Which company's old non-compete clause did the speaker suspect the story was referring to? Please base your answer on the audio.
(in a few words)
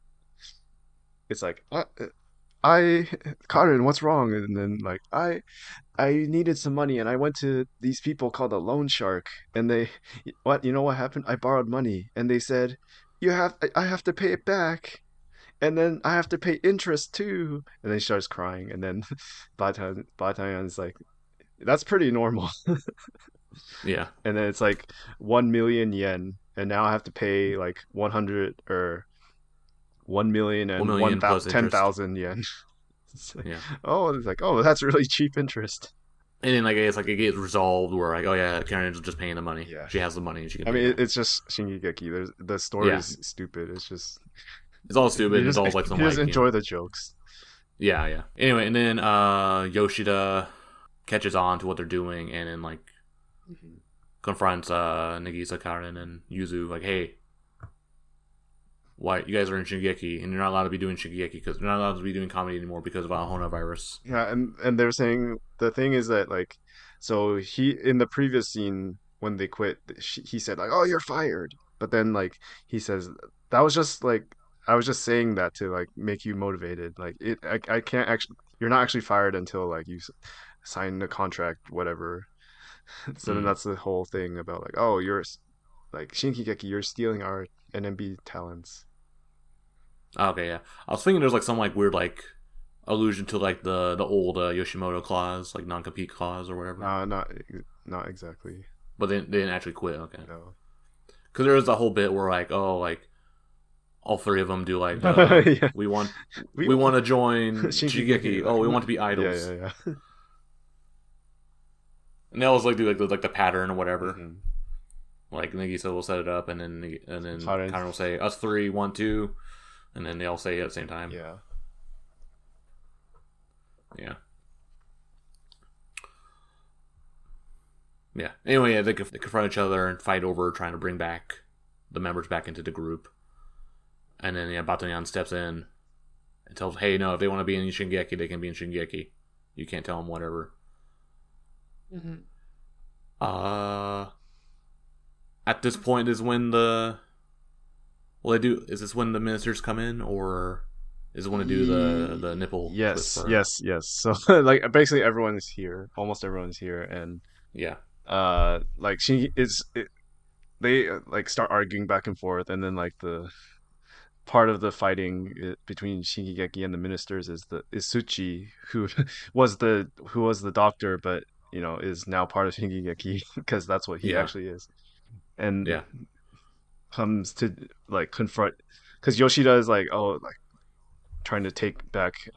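Yoshimoto.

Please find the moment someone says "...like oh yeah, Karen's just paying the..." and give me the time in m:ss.
0:38.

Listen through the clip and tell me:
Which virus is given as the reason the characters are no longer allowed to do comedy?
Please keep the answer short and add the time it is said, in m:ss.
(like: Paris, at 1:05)
Ahona virus, at 1:03.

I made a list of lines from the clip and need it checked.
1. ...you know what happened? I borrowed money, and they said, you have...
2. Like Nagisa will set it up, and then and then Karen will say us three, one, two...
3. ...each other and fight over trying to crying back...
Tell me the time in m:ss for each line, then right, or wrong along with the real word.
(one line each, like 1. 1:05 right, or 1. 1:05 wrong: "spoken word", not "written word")
1. 0:10 right
2. 1:55 right
3. 2:09 wrong: "bring", not "crying".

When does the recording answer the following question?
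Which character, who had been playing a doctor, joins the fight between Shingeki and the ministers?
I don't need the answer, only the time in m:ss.
2:47.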